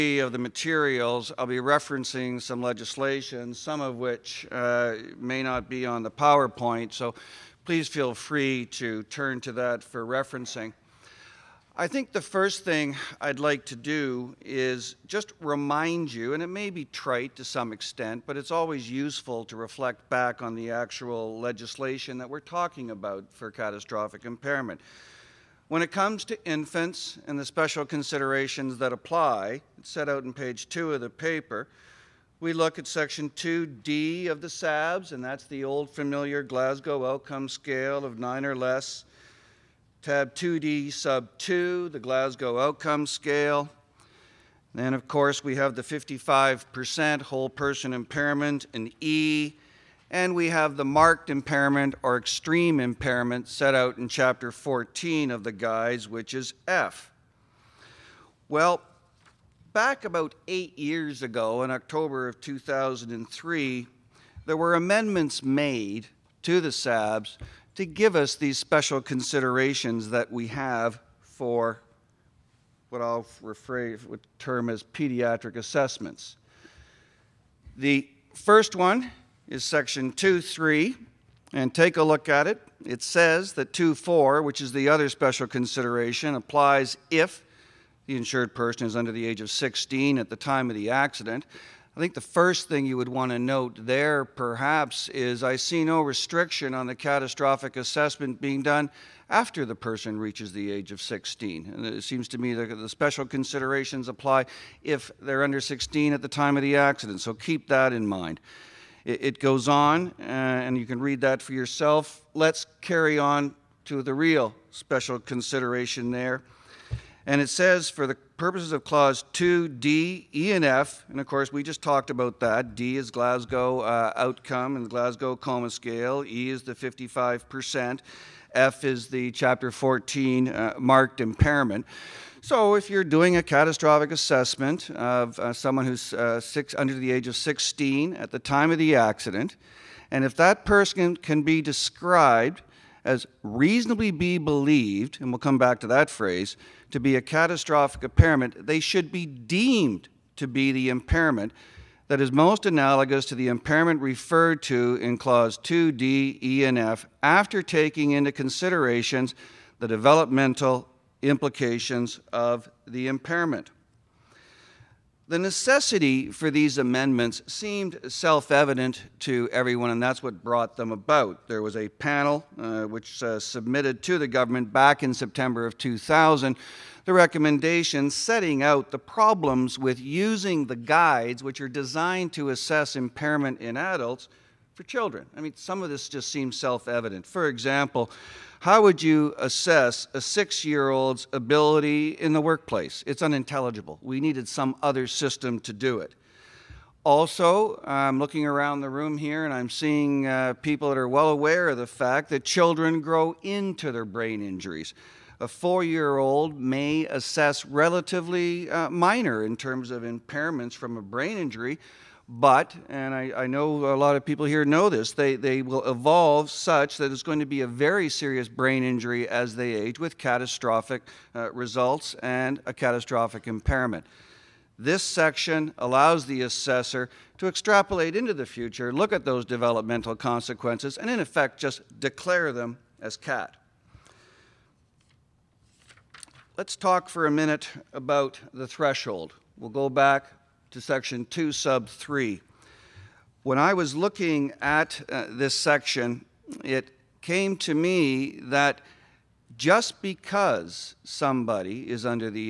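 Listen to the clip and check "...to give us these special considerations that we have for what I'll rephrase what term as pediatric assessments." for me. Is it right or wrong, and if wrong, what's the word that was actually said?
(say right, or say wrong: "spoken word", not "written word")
right.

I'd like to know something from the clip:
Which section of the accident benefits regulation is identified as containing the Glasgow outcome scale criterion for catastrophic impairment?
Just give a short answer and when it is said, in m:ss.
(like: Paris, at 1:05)
Section 2D, at 0:32.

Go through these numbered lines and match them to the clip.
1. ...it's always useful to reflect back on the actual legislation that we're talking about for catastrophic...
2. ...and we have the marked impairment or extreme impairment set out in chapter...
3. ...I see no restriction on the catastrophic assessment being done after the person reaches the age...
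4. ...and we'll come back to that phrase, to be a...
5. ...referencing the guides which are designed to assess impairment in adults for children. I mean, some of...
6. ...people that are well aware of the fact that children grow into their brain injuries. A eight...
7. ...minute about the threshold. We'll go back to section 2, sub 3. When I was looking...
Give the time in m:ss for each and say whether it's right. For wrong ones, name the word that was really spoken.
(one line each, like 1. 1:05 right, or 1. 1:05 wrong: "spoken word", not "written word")
1. 0:18 right
2. 0:50 right
3. 1:35 right
4. 2:25 right
5. 3:00 wrong: "using", not "referencing"
6. 3:20 wrong: "four", not "eight"
7. 3:57 right.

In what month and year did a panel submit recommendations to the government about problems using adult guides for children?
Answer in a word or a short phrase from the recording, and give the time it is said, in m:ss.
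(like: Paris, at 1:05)
September 2000, at 2:55.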